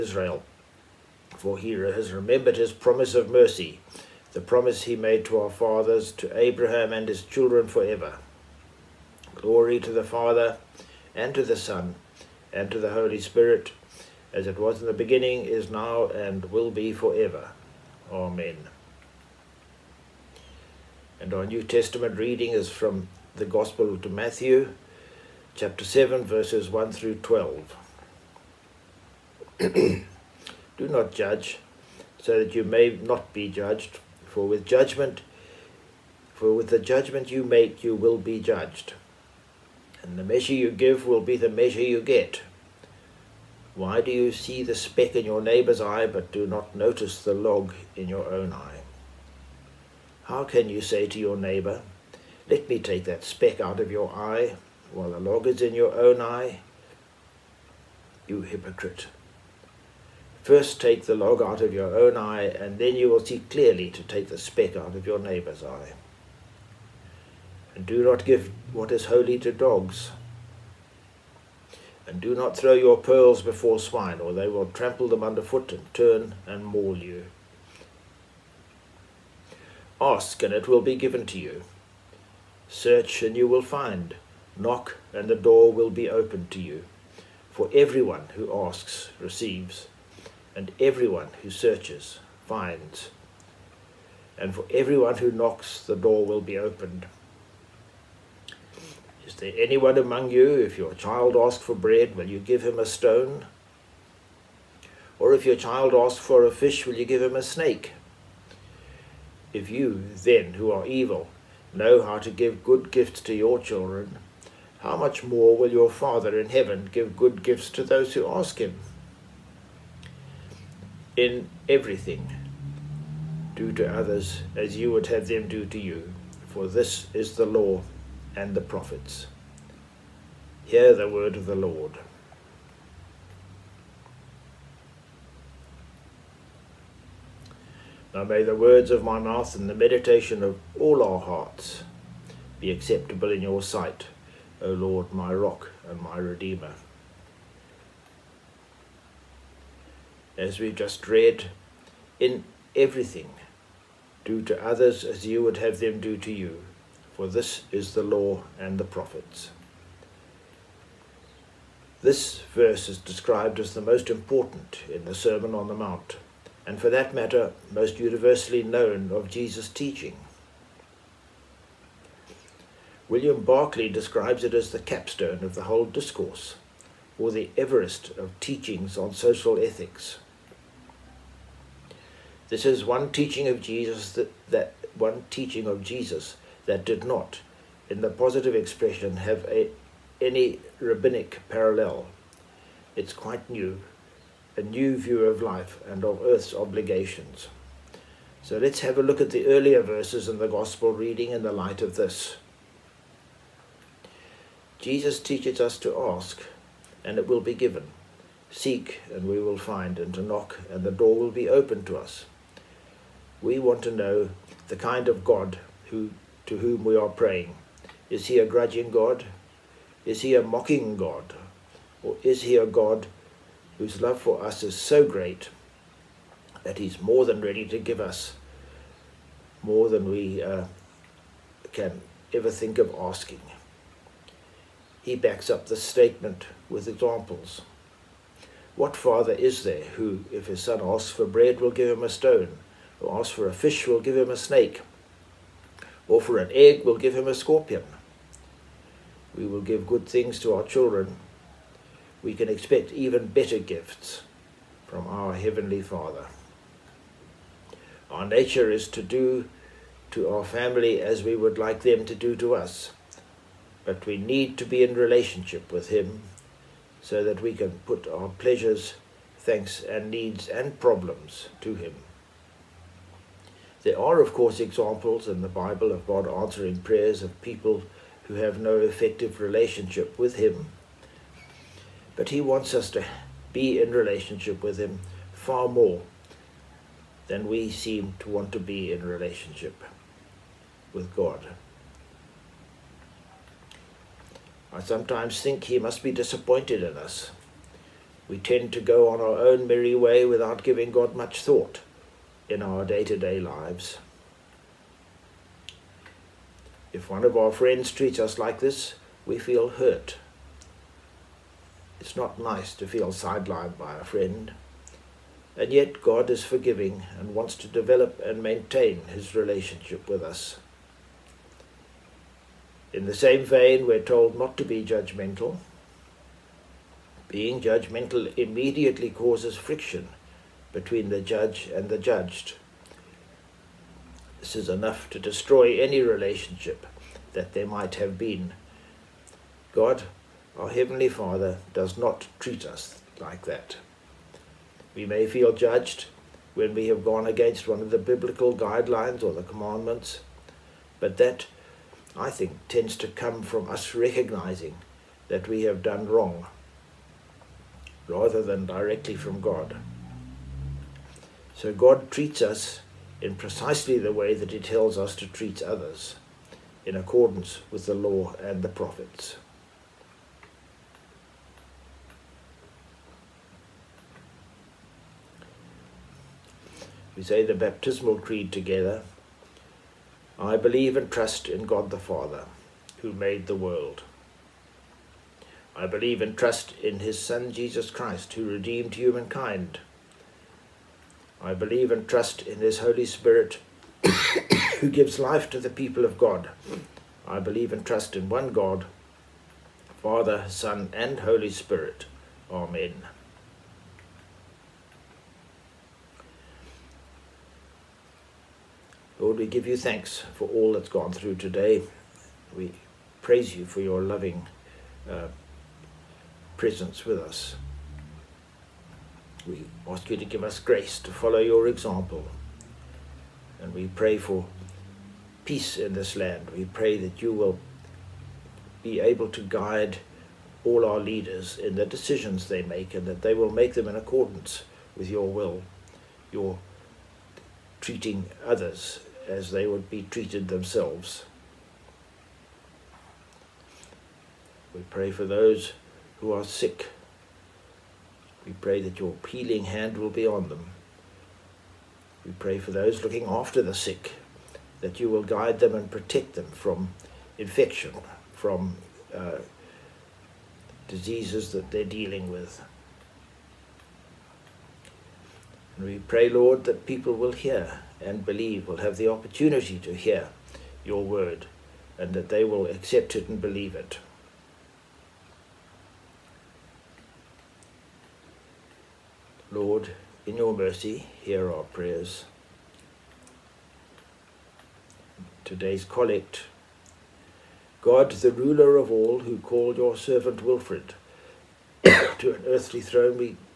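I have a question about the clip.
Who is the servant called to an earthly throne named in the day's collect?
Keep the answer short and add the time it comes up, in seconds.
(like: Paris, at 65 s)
Wilfrid, at 490 s.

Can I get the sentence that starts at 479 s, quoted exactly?
Lord, in your mercy, hear our prayers.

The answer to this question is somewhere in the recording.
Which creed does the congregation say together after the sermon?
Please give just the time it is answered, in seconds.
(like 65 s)
377 s.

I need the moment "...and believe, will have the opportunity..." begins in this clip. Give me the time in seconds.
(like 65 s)
468 s.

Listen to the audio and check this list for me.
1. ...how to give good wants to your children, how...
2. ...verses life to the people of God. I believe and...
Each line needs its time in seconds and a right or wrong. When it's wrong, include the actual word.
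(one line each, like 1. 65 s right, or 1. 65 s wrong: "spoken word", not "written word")
1. 112 s wrong: "gifts", not "wants"
2. 394 s wrong: "gives", not "verses".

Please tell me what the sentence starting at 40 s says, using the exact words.
And the measure you give will be the measure you get.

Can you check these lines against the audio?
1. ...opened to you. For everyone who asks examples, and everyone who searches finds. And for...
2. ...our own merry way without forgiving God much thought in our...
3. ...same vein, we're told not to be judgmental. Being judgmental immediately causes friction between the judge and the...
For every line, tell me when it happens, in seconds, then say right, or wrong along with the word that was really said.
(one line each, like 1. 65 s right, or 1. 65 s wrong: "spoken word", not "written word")
1. 86 s wrong: "receives", not "examples"
2. 299 s wrong: "giving", not "forgiving"
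3. 323 s right.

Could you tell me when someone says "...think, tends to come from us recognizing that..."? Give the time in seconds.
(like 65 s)
352 s.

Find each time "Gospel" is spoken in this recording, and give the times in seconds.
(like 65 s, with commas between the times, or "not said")
23 s, 200 s.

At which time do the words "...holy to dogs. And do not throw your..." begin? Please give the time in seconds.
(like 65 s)
69 s.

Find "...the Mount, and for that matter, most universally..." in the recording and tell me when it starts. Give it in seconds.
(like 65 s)
165 s.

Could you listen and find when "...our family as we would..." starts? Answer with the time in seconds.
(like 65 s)
260 s.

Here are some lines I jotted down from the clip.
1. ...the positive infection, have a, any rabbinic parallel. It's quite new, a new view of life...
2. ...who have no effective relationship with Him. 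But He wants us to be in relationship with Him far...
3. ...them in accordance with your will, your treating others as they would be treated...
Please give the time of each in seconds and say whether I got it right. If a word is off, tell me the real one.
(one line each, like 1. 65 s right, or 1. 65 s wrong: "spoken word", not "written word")
1. 188 s wrong: "expression", not "infection"
2. 278 s right
3. 433 s right.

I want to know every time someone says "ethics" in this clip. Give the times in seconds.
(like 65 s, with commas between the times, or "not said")
179 s.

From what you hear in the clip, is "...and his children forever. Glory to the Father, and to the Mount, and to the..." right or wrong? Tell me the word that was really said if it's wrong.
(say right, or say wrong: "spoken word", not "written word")
wrong: "Son", not "Mount".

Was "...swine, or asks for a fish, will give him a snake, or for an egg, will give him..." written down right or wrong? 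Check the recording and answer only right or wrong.
wrong.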